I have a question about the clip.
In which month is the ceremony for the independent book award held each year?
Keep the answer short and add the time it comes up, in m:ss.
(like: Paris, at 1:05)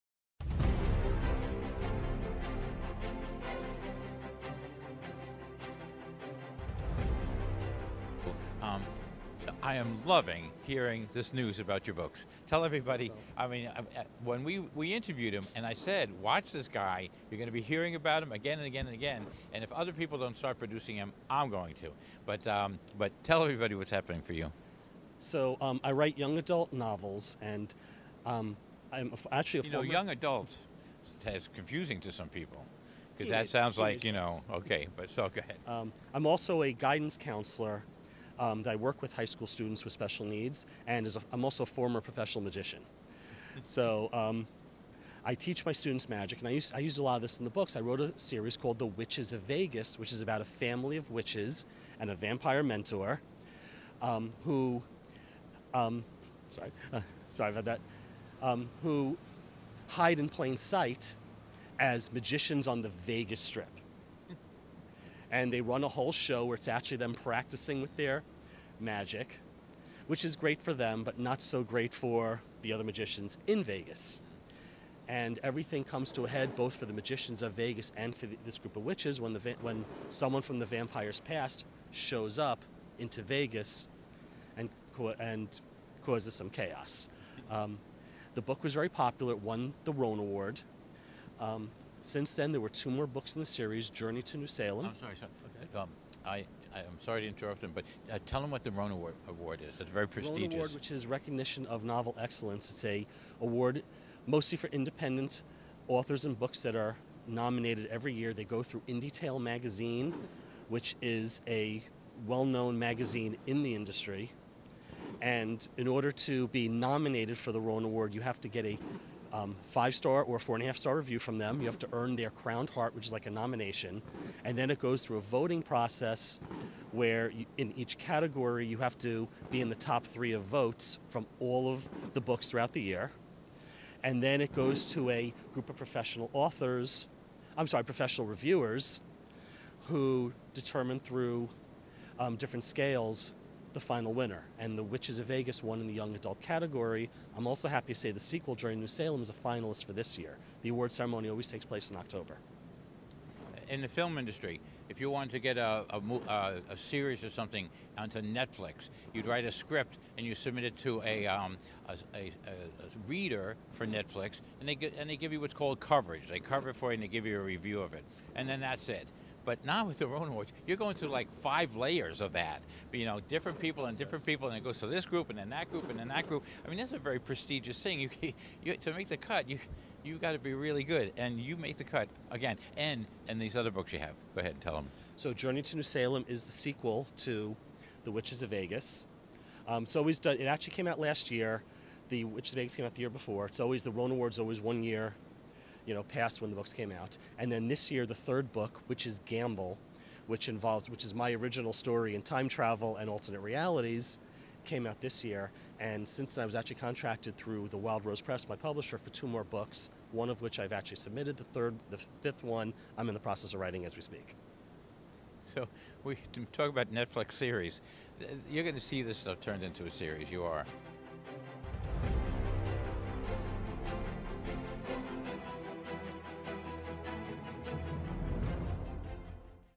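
October, at 2:31.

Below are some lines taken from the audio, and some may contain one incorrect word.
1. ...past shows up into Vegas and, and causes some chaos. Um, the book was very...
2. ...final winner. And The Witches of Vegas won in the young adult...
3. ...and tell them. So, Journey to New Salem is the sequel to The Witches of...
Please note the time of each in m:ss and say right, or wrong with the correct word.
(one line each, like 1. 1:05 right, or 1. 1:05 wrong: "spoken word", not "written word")
1. 1:21 right
2. 2:23 right
3. 3:04 right.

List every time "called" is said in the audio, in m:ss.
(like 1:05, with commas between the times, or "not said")
0:48, 2:45.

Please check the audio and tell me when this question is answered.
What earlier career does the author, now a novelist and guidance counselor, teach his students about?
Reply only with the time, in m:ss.
0:42.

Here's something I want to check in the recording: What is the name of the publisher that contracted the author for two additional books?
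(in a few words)
The Wild Rose Press.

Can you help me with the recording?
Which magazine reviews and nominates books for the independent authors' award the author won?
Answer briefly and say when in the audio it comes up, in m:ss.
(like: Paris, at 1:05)
Tale magazine, at 1:49.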